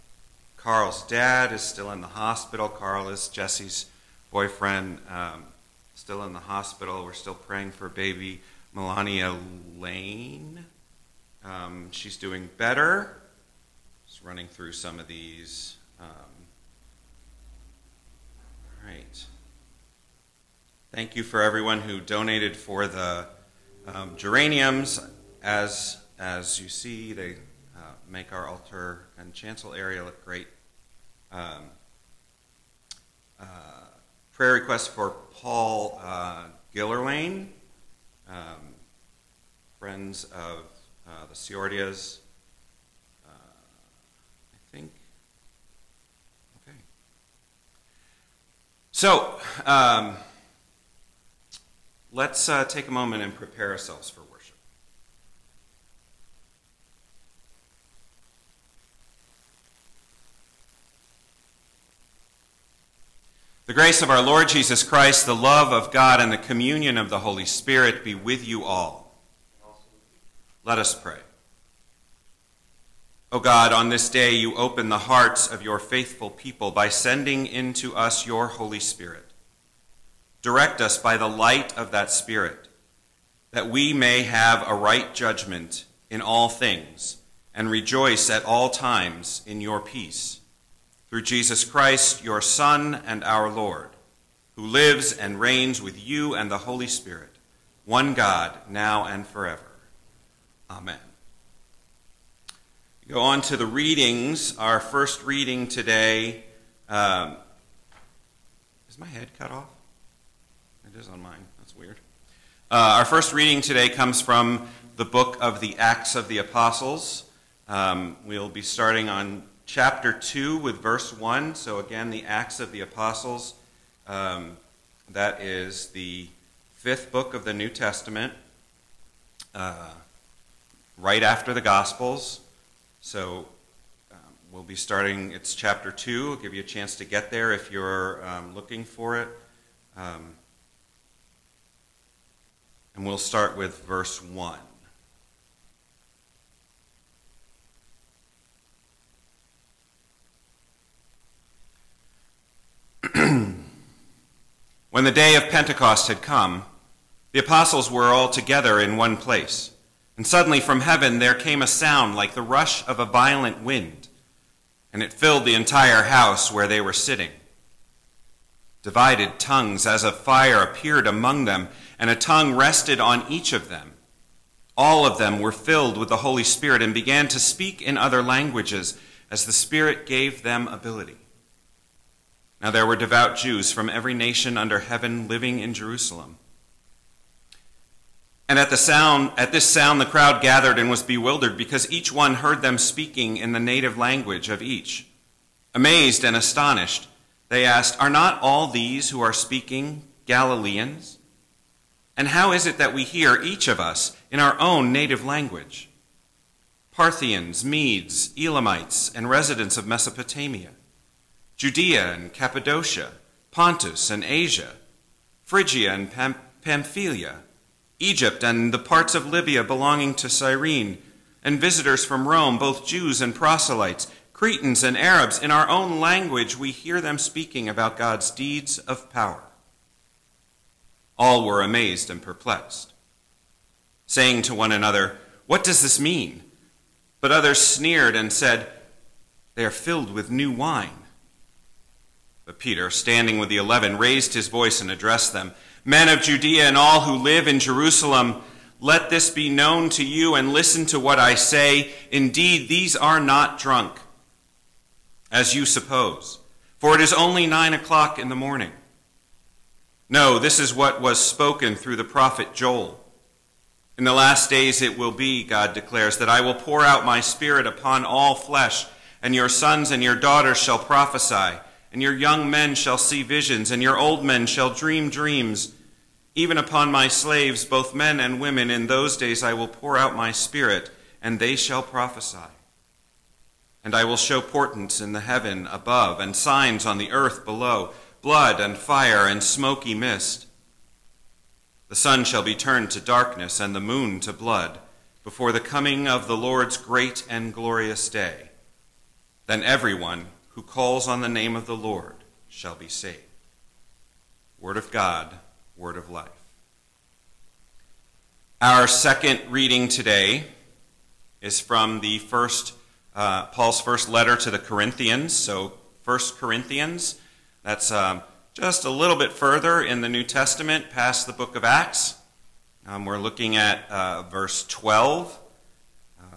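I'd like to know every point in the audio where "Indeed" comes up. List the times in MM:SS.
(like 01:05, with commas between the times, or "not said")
04:12.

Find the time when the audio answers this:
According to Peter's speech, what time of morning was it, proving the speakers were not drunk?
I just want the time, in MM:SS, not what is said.
04:17.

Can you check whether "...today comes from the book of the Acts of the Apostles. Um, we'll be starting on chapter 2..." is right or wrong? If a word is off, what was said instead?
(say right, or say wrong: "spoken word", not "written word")
right.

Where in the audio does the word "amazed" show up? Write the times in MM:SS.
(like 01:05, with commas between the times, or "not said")
03:15, 03:51.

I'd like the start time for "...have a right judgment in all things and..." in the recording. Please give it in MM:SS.
01:24.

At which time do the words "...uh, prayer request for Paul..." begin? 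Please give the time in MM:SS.
00:33.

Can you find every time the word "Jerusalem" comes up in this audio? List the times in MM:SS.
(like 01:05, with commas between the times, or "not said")
03:05, 04:07.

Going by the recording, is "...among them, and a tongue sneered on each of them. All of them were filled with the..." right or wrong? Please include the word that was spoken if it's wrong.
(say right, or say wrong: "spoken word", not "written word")
wrong: "rested", not "sneered".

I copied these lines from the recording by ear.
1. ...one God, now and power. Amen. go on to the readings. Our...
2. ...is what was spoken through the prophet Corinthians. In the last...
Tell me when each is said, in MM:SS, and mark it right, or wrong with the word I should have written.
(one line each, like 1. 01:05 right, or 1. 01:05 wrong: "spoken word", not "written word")
1. 01:37 wrong: "forever", not "power"
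2. 04:20 wrong: "Joel", not "Corinthians".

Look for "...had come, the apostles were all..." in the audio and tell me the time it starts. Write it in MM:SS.
02:36.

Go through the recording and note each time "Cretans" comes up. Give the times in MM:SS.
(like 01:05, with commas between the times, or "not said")
03:44.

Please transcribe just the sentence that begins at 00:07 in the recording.
We're still praying for baby Melania Lane.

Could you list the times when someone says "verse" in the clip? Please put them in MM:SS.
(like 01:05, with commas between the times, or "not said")
02:00, 02:23, 05:24.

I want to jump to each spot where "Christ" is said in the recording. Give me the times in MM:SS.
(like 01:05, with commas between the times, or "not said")
01:04, 01:31.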